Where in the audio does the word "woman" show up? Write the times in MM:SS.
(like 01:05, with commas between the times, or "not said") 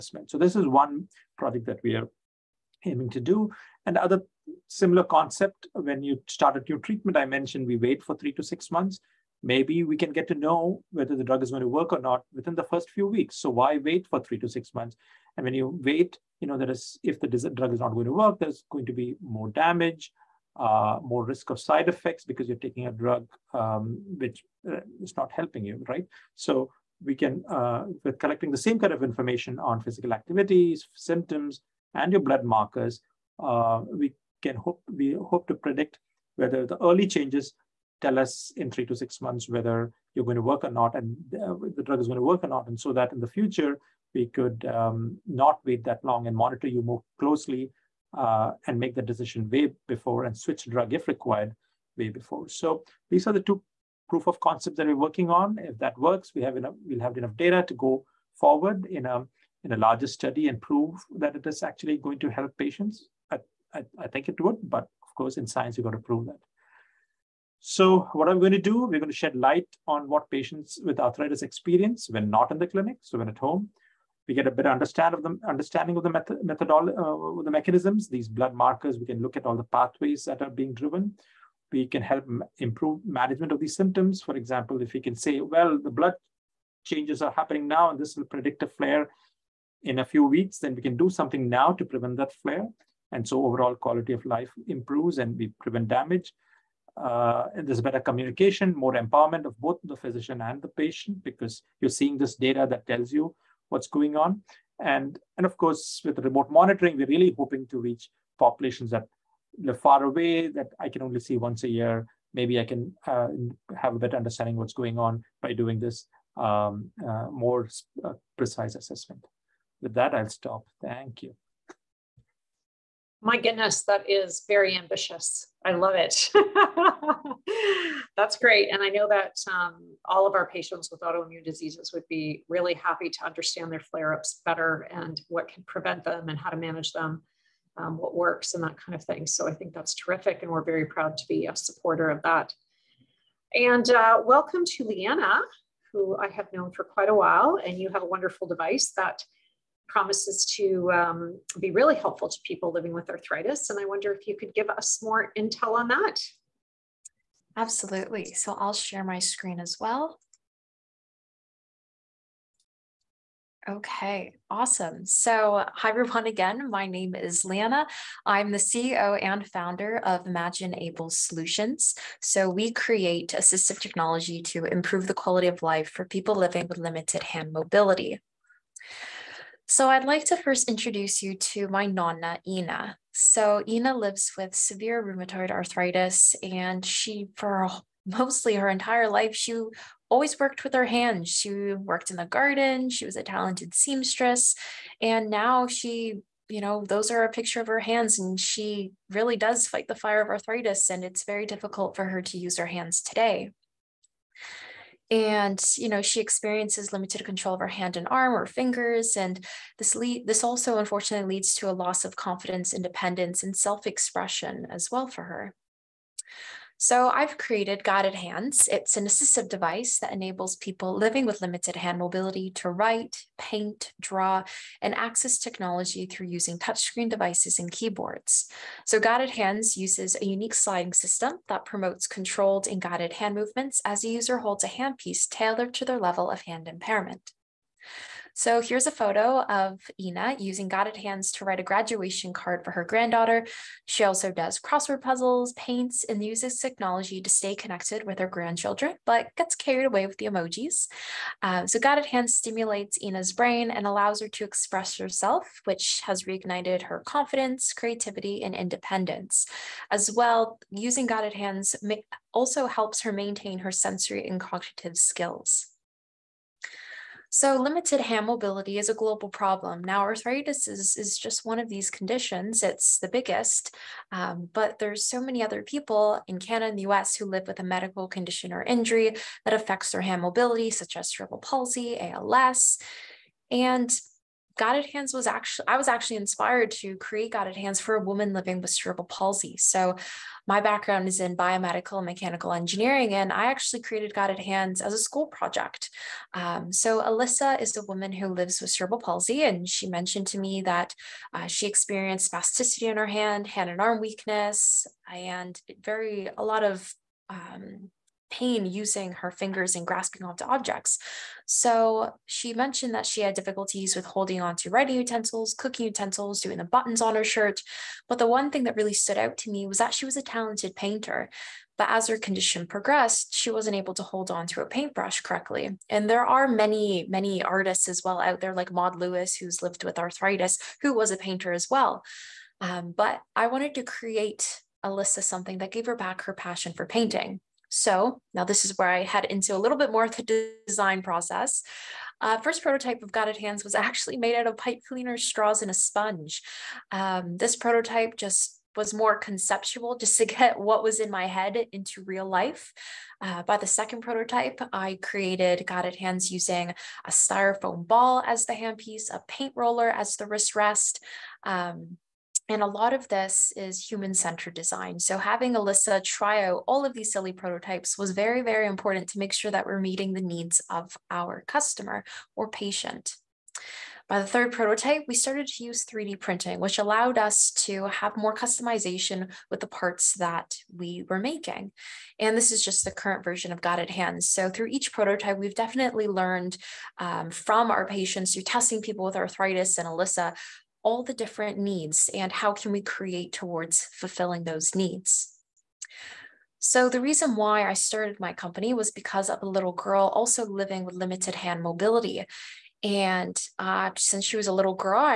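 04:48, 04:57.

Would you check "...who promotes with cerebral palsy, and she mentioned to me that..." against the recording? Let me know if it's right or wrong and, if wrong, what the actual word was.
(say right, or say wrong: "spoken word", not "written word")
wrong: "lives", not "promotes".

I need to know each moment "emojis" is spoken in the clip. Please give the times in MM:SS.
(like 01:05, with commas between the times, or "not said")
04:10.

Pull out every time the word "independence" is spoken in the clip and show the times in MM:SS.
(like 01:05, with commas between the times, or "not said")
03:32, 04:18.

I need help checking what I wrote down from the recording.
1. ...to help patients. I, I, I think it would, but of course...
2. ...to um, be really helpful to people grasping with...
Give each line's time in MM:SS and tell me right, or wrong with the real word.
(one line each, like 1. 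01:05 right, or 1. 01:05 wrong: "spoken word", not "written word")
1. 01:02 right
2. 02:30 wrong: "living", not "grasping".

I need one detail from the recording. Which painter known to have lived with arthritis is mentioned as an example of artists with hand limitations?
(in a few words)
Maud Lewis.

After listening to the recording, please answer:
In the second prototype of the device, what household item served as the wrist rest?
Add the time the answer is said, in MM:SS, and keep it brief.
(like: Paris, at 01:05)
a paint roller, at 05:59.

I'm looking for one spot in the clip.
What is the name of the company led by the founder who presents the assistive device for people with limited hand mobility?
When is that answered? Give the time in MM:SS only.
02:50.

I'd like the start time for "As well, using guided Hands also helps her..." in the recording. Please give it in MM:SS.
04:19.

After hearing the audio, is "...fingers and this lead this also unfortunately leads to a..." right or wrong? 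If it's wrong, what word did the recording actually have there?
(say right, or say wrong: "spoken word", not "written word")
right.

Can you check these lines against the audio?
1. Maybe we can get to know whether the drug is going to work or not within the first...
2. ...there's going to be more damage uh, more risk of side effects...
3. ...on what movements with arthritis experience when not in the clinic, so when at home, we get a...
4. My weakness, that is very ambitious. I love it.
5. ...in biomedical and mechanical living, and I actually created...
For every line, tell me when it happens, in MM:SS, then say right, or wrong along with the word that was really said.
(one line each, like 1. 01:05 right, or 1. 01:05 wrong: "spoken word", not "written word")
1. 00:09 right
2. 00:18 right
3. 01:09 wrong: "patients", not "movements"
4. 02:03 wrong: "goodness", not "weakness"
5. 04:51 wrong: "engineering", not "living".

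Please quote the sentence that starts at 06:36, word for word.
So, the reason why I started my company was because of a little girl also living with limited hand mobility.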